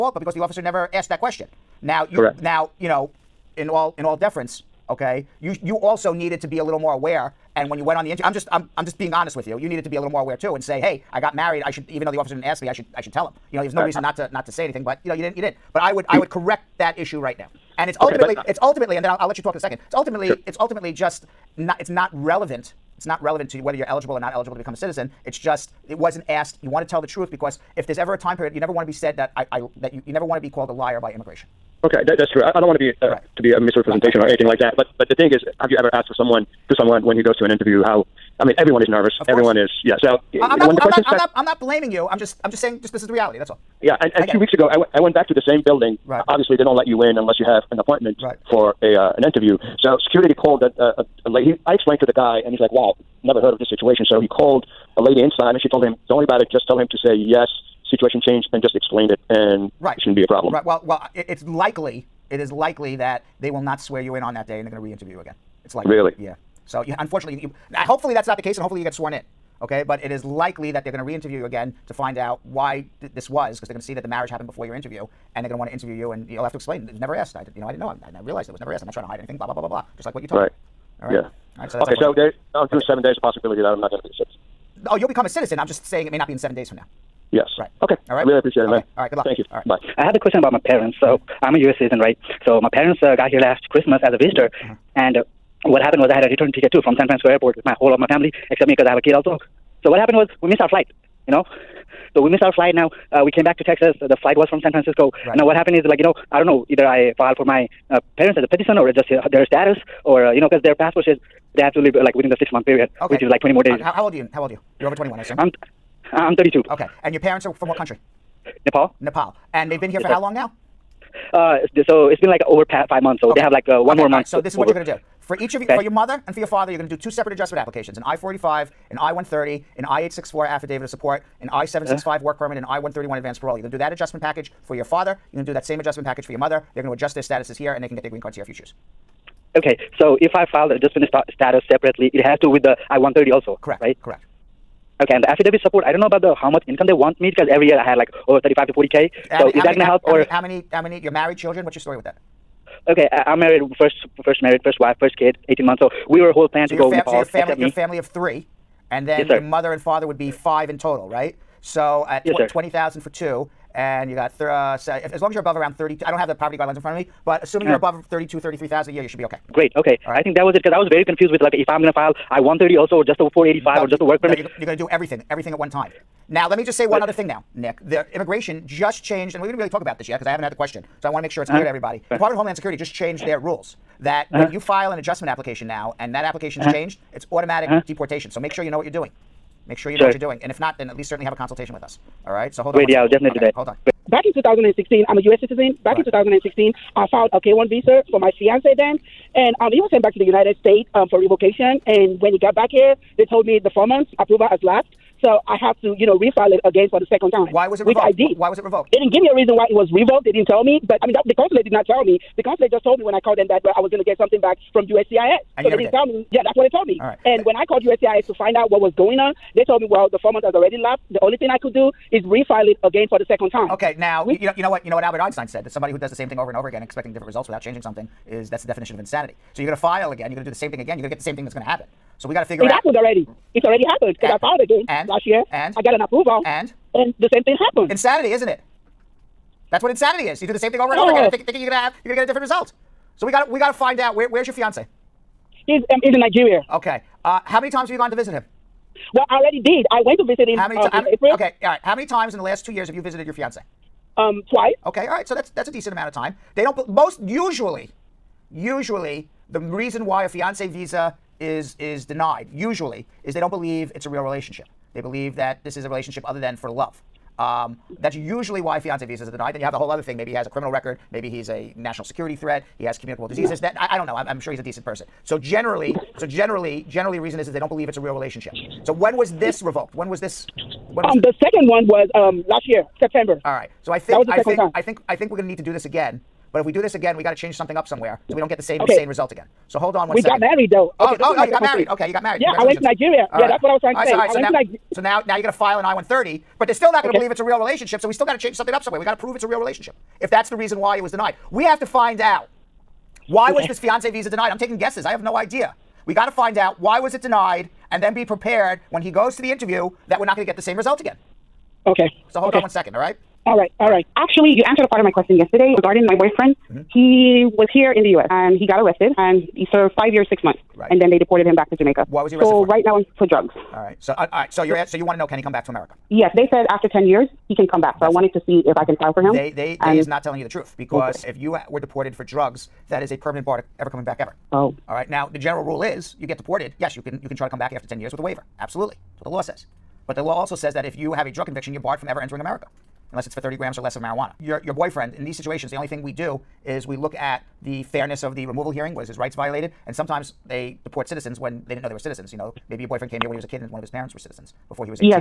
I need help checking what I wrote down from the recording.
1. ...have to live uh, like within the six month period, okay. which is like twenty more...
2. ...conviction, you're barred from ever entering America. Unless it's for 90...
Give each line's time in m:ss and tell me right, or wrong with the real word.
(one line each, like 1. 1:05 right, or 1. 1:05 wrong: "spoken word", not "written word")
1. 1:51 right
2. 5:41 wrong: "30", not "90".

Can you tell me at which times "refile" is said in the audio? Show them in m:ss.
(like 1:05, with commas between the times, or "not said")
3:26, 3:42.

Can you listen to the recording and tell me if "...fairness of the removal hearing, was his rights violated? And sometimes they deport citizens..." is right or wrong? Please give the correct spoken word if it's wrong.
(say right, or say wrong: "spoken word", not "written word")
right.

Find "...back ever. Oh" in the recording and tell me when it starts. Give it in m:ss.
5:34.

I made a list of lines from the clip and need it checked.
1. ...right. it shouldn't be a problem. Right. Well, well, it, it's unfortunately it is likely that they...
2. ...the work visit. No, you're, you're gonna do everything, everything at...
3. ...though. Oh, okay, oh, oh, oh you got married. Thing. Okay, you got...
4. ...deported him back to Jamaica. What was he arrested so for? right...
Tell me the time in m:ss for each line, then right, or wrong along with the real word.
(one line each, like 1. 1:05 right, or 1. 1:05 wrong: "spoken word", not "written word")
1. 0:59 wrong: "likely", not "unfortunately"
2. 2:53 wrong: "permit", not "visit"
3. 4:50 right
4. 5:21 right.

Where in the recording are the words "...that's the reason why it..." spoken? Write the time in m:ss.
5:00.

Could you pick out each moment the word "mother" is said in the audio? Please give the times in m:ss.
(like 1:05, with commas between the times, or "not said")
2:05, 2:16, 2:39.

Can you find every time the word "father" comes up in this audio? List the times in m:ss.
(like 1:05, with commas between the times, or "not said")
2:06, 2:14, 2:39.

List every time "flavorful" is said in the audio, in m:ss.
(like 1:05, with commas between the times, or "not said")
not said.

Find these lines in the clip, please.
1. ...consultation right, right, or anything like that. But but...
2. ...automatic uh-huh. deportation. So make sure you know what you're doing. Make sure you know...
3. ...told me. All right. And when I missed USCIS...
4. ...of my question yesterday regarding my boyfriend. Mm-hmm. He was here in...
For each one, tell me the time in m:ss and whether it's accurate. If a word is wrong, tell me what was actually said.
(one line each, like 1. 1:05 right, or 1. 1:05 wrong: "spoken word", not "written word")
1. 0:33 wrong: "misrepresentation", not "consultation"
2. 3:07 right
3. 3:36 wrong: "called", not "missed"
4. 5:14 right.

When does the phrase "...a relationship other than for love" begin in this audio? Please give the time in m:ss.
4:25.